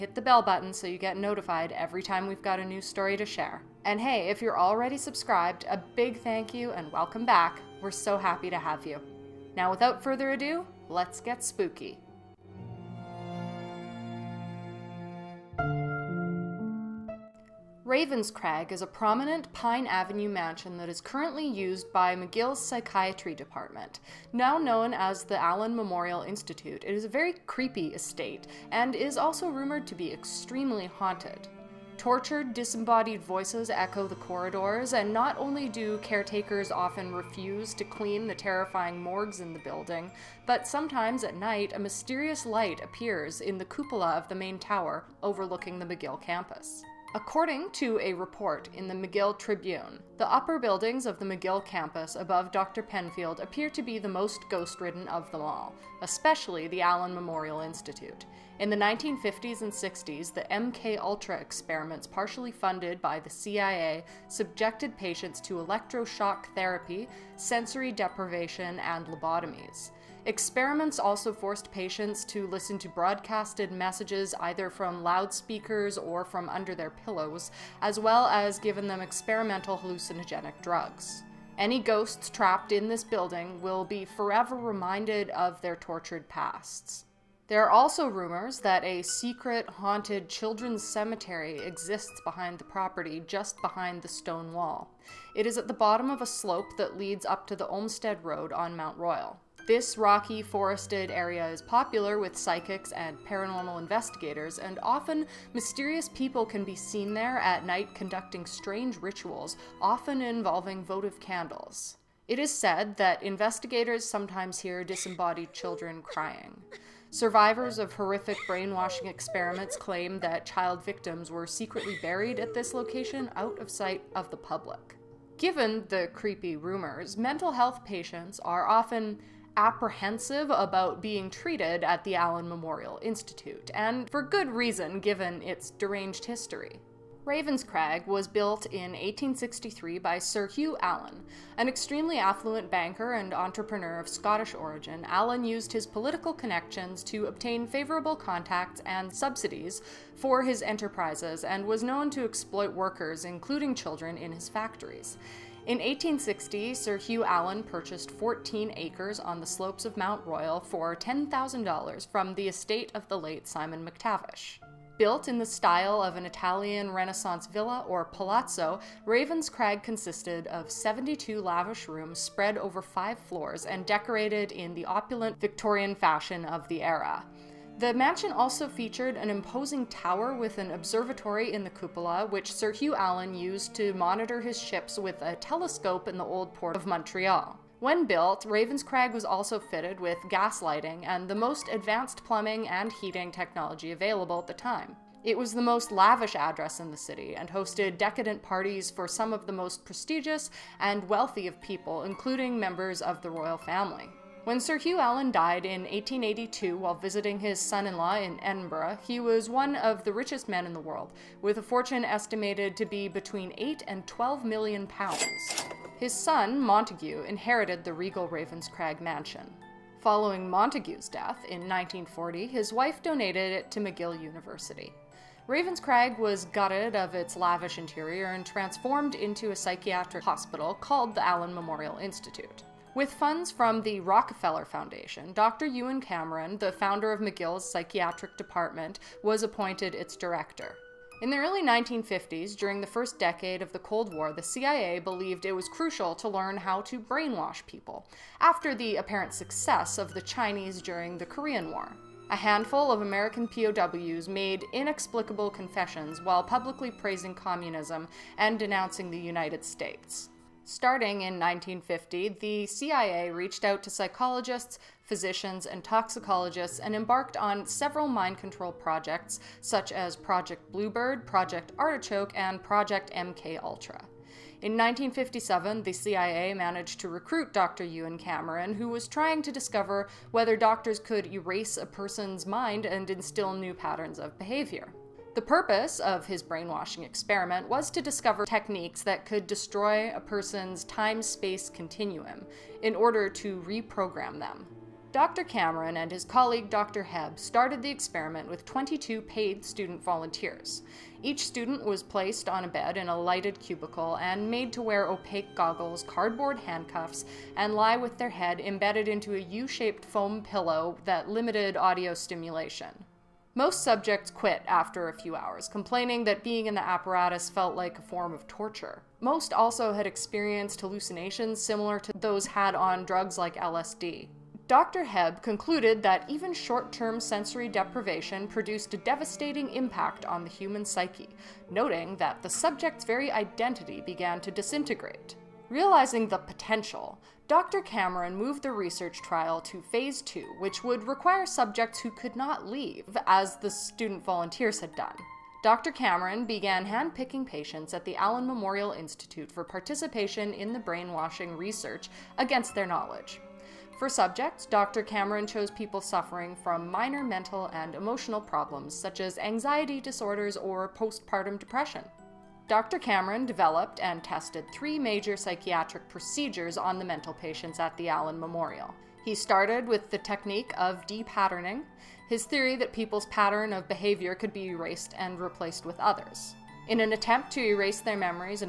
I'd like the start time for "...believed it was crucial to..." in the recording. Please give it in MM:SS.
04:04.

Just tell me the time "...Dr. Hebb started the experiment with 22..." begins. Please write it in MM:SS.
04:56.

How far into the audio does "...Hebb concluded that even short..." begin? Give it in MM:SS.
05:25.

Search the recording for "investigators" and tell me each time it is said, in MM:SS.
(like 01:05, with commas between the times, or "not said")
01:43, 01:53.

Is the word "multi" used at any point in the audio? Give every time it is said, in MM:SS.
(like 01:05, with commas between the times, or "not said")
not said.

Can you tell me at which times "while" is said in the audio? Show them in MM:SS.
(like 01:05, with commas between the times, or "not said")
03:26, 04:16.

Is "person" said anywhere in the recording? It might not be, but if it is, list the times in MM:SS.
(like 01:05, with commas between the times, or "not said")
04:41, 04:50.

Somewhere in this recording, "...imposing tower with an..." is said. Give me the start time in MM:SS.
02:59.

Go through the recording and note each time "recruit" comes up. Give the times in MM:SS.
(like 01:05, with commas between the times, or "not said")
04:37.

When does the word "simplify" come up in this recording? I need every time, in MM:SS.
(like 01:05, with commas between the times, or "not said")
not said.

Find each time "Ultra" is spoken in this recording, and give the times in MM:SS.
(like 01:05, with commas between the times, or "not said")
01:00, 04:33.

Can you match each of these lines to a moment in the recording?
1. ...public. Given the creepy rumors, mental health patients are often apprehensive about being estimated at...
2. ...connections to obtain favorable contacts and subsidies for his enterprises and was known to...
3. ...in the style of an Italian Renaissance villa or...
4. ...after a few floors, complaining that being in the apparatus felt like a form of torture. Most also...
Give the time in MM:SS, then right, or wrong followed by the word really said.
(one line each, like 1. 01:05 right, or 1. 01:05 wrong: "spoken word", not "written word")
1. 02:04 wrong: "treated", not "estimated"
2. 02:26 right
3. 02:45 right
4. 05:14 wrong: "hours", not "floors".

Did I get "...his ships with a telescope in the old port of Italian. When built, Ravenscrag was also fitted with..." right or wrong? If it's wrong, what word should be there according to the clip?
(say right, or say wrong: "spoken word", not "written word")
wrong: "Montreal", not "Italian".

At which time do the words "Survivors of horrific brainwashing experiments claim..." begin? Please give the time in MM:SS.
01:57.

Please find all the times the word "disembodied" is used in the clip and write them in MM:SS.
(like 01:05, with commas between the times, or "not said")
00:32, 01:54.